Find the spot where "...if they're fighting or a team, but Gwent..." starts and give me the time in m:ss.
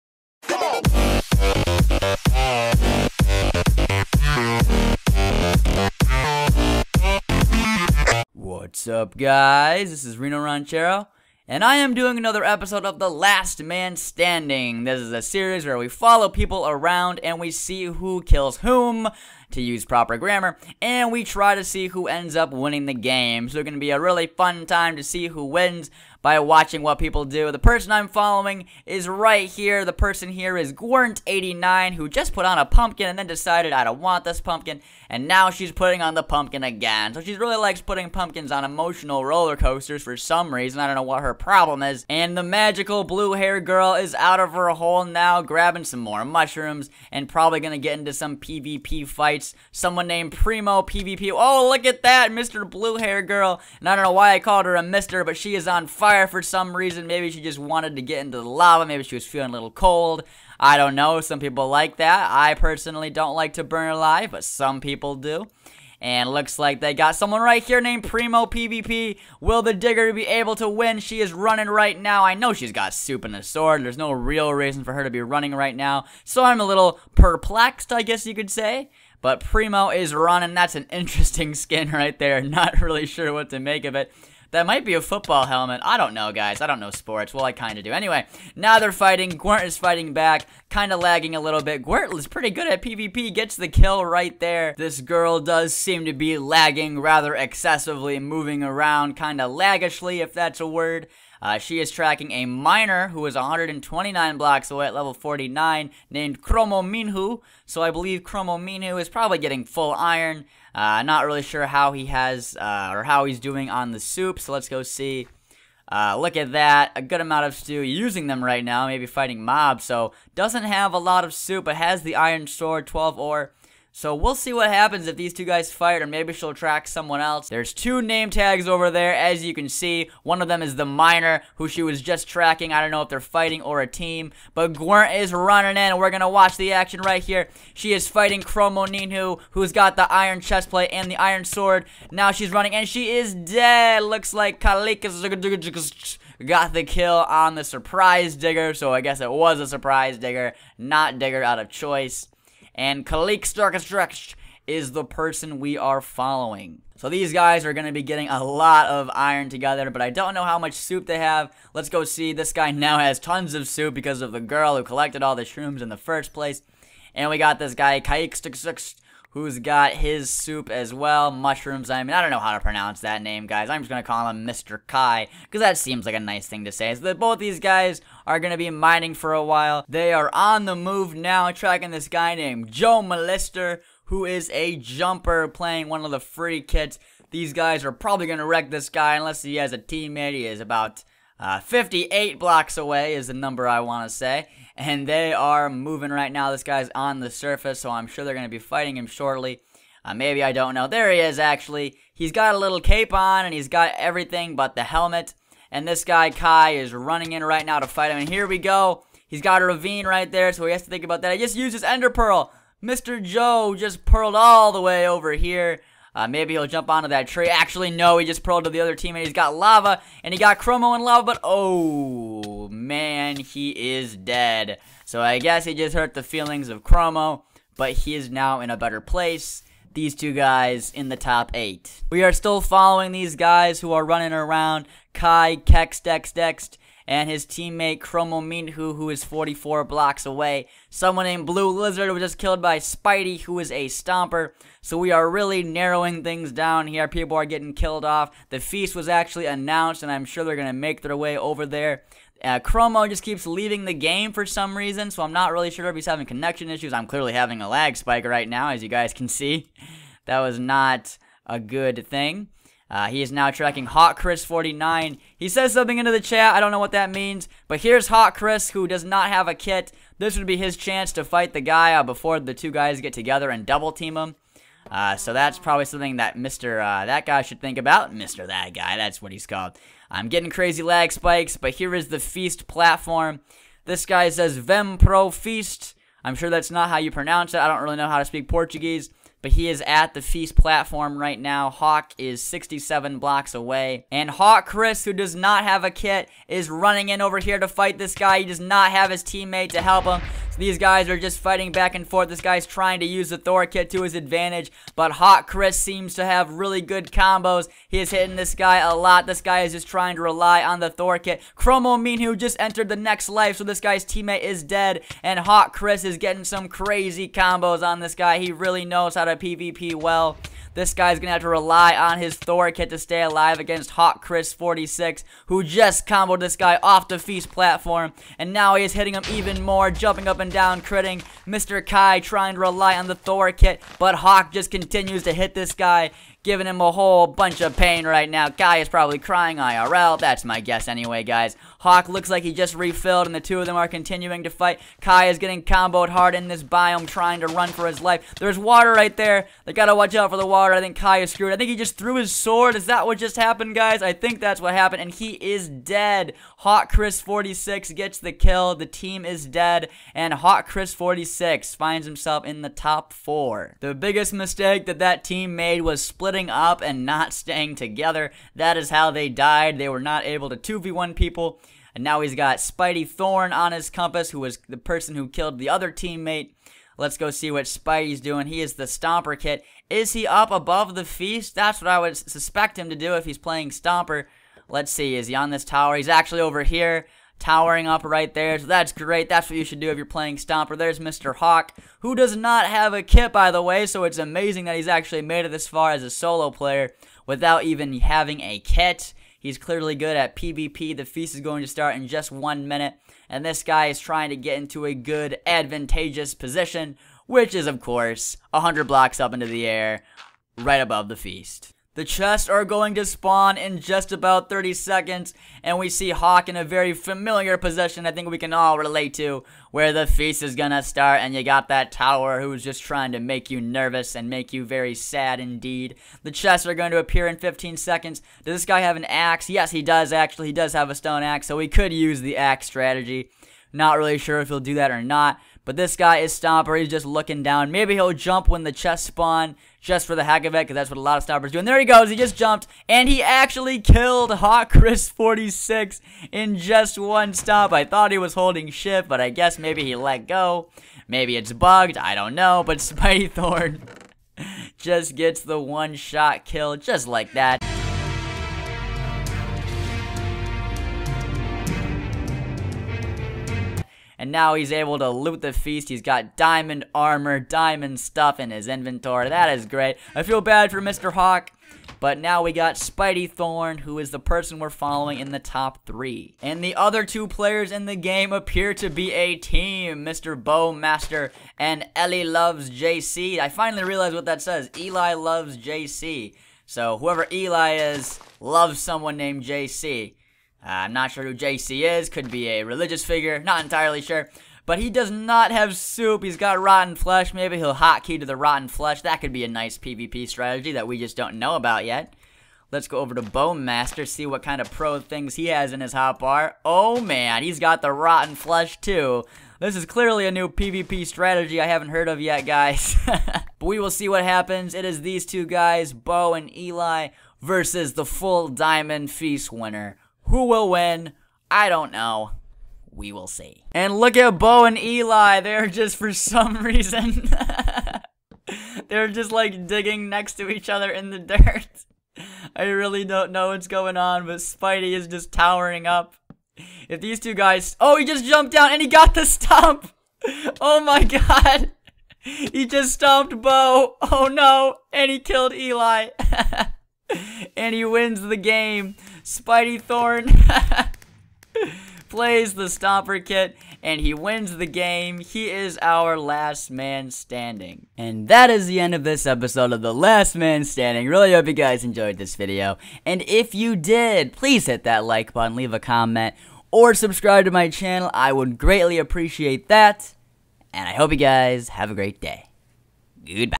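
2:13.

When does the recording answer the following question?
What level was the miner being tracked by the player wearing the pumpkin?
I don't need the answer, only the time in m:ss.
1:44.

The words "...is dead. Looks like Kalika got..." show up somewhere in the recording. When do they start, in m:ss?
2:23.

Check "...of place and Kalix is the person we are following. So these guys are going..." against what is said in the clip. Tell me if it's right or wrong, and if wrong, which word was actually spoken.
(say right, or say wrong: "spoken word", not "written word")
wrong: "choice", not "place".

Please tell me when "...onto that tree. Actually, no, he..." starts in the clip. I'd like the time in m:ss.
3:36.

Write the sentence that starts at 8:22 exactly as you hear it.
Let's go over to Bowmaster, see what kind of pro things he has in his hotbar.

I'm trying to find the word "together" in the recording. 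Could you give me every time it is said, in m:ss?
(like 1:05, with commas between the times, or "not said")
2:39, 4:33, 6:07.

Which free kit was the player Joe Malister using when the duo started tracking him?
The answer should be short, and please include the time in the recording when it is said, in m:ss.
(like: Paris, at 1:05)
Jumper, at 3:04.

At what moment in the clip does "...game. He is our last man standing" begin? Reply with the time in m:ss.
9:14.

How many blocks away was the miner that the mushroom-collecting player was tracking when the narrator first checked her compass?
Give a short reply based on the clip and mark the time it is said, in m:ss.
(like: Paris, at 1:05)
129, at 1:43.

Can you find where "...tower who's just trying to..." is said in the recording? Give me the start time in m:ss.
7:01.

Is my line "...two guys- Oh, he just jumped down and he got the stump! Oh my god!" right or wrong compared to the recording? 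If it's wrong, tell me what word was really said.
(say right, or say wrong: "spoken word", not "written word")
right.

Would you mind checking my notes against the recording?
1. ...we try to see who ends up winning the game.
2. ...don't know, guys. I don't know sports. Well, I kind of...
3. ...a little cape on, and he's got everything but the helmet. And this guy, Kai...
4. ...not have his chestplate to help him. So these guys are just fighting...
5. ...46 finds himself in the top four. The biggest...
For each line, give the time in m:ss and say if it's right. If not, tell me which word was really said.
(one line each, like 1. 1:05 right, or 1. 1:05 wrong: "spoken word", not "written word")
1. 0:21 right
2. 1:25 right
3. 3:22 right
4. 4:58 wrong: "teammate", not "chestplate"
5. 6:00 right.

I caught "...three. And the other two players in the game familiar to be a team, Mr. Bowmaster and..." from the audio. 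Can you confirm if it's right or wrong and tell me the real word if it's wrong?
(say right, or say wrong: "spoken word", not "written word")
wrong: "appear", not "familiar".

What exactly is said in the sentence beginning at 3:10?
He is about uh, 58 blocks away is the number I want to say and they are moving right now.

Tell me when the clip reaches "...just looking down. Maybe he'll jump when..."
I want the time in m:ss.
7:16.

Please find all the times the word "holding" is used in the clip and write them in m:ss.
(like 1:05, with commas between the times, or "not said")
7:28.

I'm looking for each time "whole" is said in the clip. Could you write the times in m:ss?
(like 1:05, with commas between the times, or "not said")
5:36.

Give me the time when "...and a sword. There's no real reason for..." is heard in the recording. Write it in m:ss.
1:13.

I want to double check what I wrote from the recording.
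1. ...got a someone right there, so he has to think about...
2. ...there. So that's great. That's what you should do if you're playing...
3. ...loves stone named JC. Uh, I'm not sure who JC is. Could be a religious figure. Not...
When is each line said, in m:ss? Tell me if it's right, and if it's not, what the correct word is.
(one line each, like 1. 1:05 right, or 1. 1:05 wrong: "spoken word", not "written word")
1. 3:29 wrong: "ravine", not "someone"
2. 6:28 right
3. 8:08 wrong: "someone", not "stone".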